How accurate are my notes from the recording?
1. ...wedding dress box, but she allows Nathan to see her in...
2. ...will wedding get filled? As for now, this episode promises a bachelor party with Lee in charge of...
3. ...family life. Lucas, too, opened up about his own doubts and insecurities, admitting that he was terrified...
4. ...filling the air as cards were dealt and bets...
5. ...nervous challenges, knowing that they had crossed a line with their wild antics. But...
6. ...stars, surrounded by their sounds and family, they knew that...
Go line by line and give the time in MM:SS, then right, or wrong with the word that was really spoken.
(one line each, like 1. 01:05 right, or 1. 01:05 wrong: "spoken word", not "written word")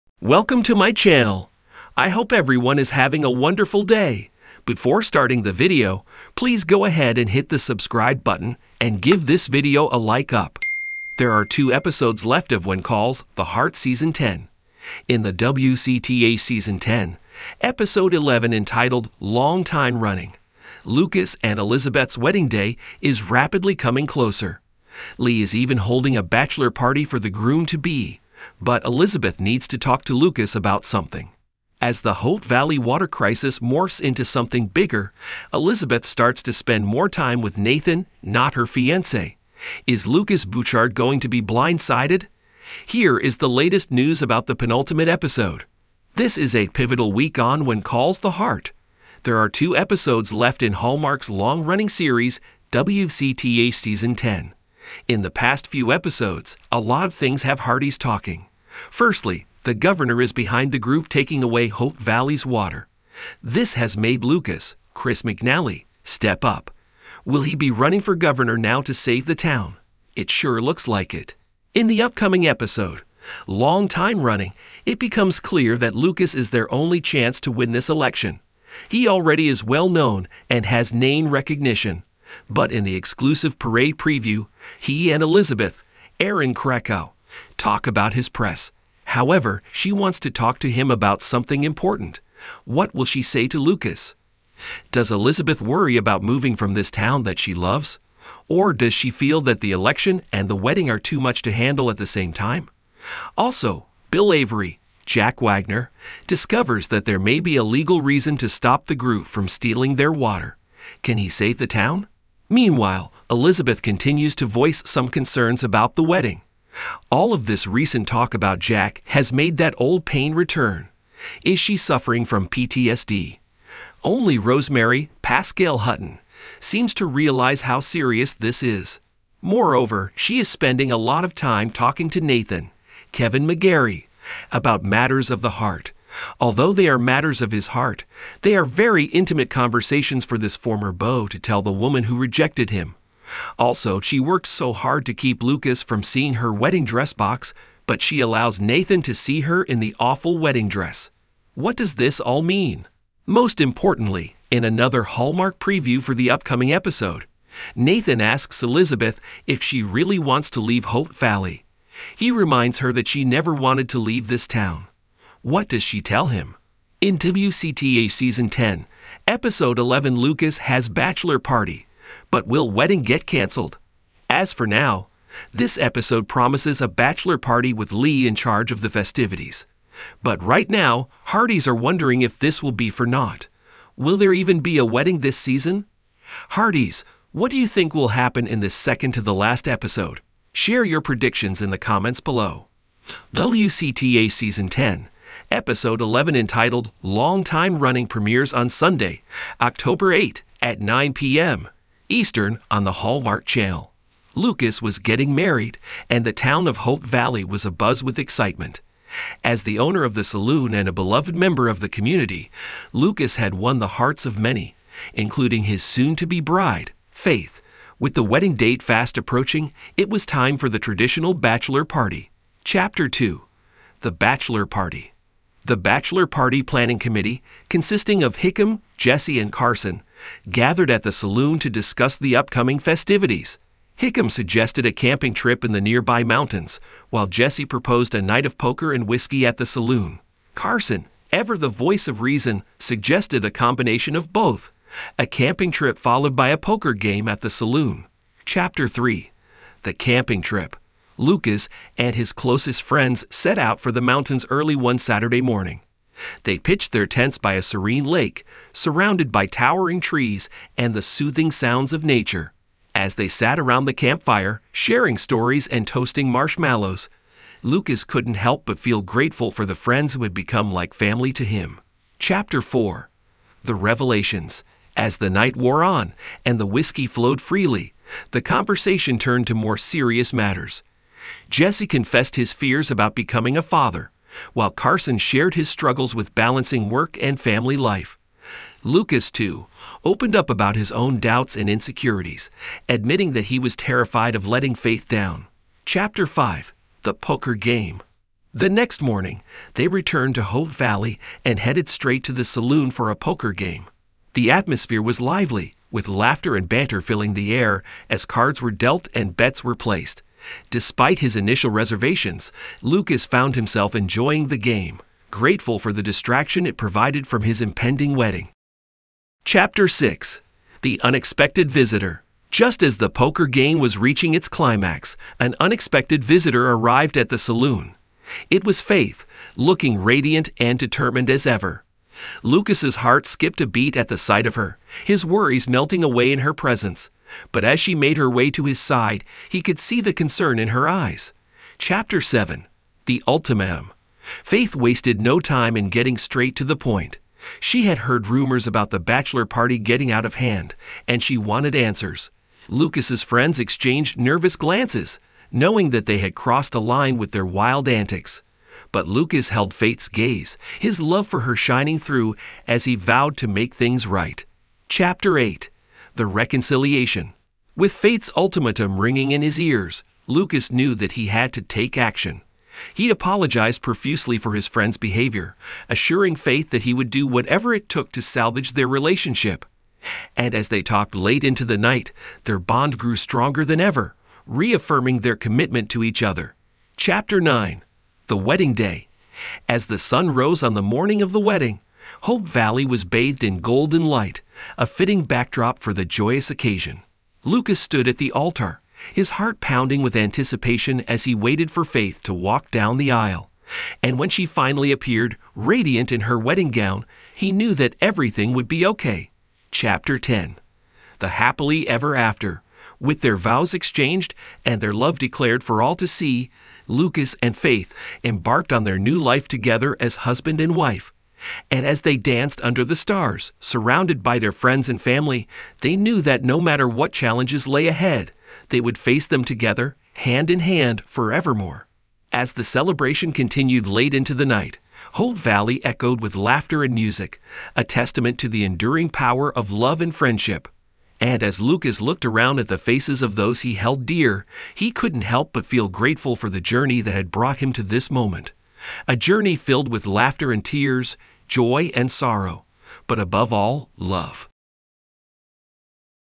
1. 02:26 right
2. 02:52 wrong: "canceled", not "filled"
3. 04:47 right
4. 05:07 right
5. 05:54 wrong: "glances", not "challenges"
6. 07:02 wrong: "friends", not "sounds".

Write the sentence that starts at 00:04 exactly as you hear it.
Before starting the video, please go ahead and hit the subscribe button and give this video a like up.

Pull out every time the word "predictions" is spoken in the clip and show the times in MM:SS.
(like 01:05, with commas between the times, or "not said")
03:11.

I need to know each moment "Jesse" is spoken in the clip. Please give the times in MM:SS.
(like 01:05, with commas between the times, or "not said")
03:48, 03:57, 04:41.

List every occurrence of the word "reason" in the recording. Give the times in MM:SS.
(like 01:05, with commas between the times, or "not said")
01:48, 04:02.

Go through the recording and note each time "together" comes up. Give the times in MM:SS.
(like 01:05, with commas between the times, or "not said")
06:59, 07:09.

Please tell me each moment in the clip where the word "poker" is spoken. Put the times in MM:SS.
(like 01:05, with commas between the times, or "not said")
03:58, 04:06, 04:57, 05:03, 05:23.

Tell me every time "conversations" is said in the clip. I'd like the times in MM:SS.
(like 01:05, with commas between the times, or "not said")
02:19, 04:38.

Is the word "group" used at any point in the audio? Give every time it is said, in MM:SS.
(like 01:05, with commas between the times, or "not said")
01:00, 01:48.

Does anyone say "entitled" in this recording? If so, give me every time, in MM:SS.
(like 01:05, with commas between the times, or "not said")
00:18, 03:16.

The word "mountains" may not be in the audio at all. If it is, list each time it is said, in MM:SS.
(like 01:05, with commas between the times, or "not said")
03:56, 04:14.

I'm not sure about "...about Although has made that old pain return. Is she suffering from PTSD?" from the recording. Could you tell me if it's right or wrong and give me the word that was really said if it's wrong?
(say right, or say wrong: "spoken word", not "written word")
wrong: "Jack", not "Although".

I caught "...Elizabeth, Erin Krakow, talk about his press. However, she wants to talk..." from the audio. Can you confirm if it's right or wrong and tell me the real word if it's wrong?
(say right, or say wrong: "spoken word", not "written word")
right.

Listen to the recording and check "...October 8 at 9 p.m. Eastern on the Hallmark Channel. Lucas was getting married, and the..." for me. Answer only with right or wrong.
right.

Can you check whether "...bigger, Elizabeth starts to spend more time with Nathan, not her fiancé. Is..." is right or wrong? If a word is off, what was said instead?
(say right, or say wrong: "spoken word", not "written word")
right.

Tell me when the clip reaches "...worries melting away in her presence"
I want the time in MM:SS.
05:35.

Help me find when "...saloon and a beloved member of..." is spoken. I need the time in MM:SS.
03:30.